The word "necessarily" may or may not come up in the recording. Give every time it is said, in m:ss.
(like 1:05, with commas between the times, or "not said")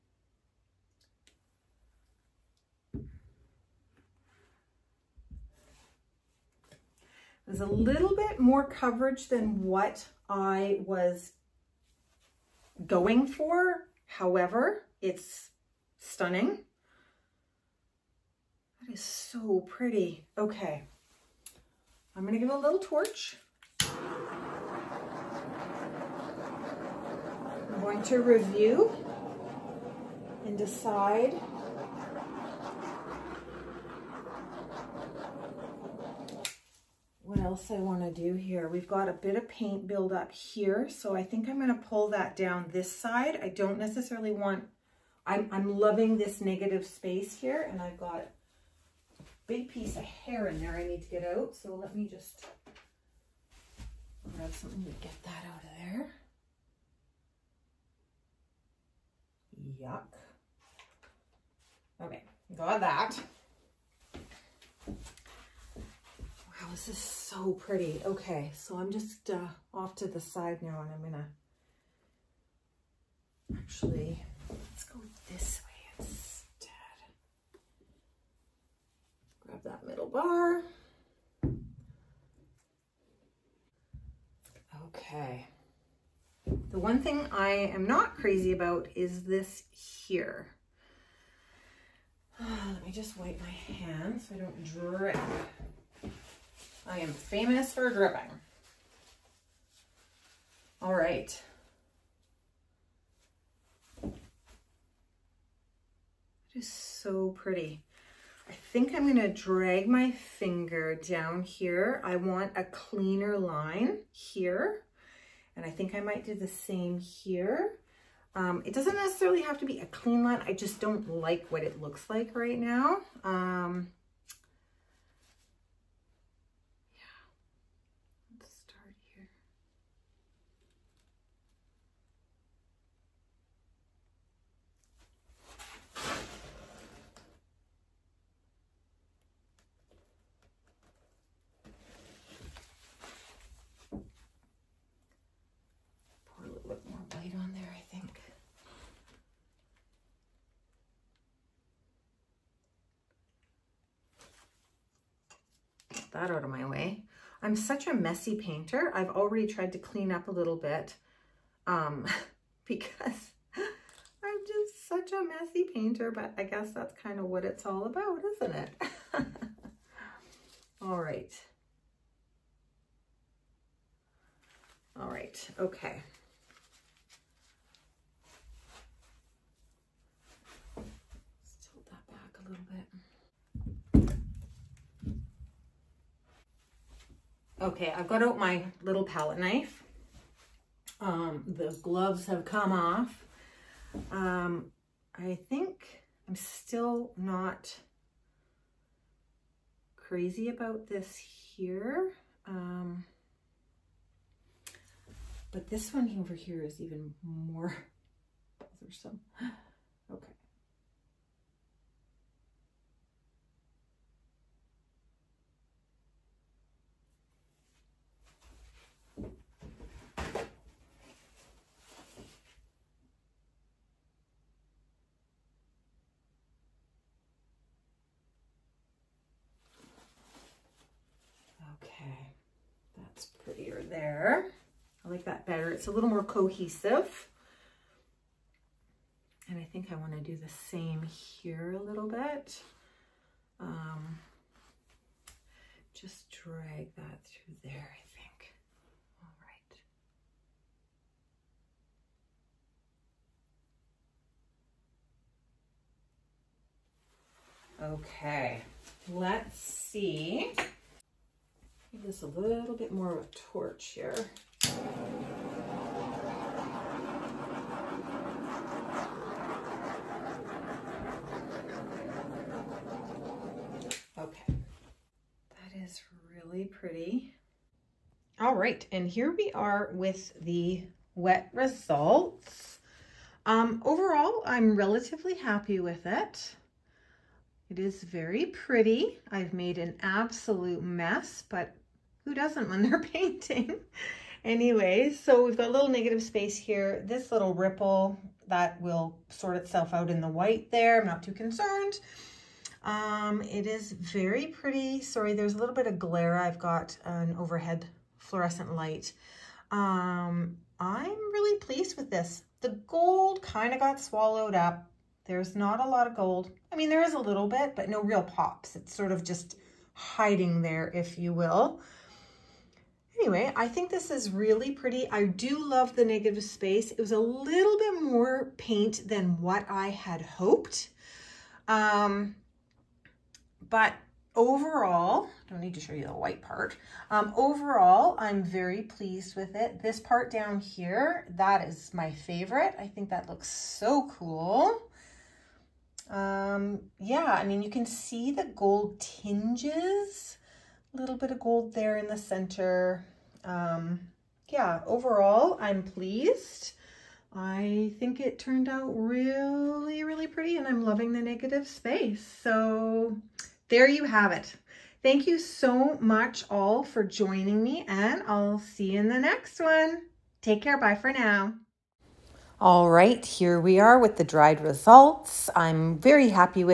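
0:43, 1:58.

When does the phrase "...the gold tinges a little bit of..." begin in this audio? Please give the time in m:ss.
5:48.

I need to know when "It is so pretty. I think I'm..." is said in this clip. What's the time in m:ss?
1:44.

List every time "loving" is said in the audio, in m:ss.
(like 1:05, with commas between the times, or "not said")
0:45, 6:00.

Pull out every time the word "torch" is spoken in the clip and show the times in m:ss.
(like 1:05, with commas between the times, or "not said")
0:22, 4:23.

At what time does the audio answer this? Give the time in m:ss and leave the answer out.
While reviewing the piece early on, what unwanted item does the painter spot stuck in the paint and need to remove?
0:49.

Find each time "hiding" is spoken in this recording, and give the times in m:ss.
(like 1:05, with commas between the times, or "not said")
5:19.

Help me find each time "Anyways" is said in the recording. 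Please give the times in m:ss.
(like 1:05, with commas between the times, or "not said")
4:54, 5:23.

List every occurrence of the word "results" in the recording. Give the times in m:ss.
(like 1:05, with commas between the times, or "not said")
4:41, 6:14.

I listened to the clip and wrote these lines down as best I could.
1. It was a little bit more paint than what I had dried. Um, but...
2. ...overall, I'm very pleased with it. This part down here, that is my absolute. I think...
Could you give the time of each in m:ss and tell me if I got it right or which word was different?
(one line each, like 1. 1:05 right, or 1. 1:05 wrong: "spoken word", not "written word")
1. 5:26 wrong: "hoped", not "dried"
2. 5:37 wrong: "favorite", not "absolute".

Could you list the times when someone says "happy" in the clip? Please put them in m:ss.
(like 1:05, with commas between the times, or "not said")
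4:45.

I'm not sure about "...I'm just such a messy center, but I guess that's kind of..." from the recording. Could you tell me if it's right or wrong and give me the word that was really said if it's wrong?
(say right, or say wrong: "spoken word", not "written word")
wrong: "painter", not "center".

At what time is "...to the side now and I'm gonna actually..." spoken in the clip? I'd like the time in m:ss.
1:09.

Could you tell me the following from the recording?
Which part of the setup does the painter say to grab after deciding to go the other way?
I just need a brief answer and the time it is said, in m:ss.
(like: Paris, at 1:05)
middle bar, at 1:19.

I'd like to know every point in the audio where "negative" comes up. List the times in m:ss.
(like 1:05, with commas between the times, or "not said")
0:46, 4:55, 5:26, 6:01.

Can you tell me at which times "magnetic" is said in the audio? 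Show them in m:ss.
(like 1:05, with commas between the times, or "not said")
not said.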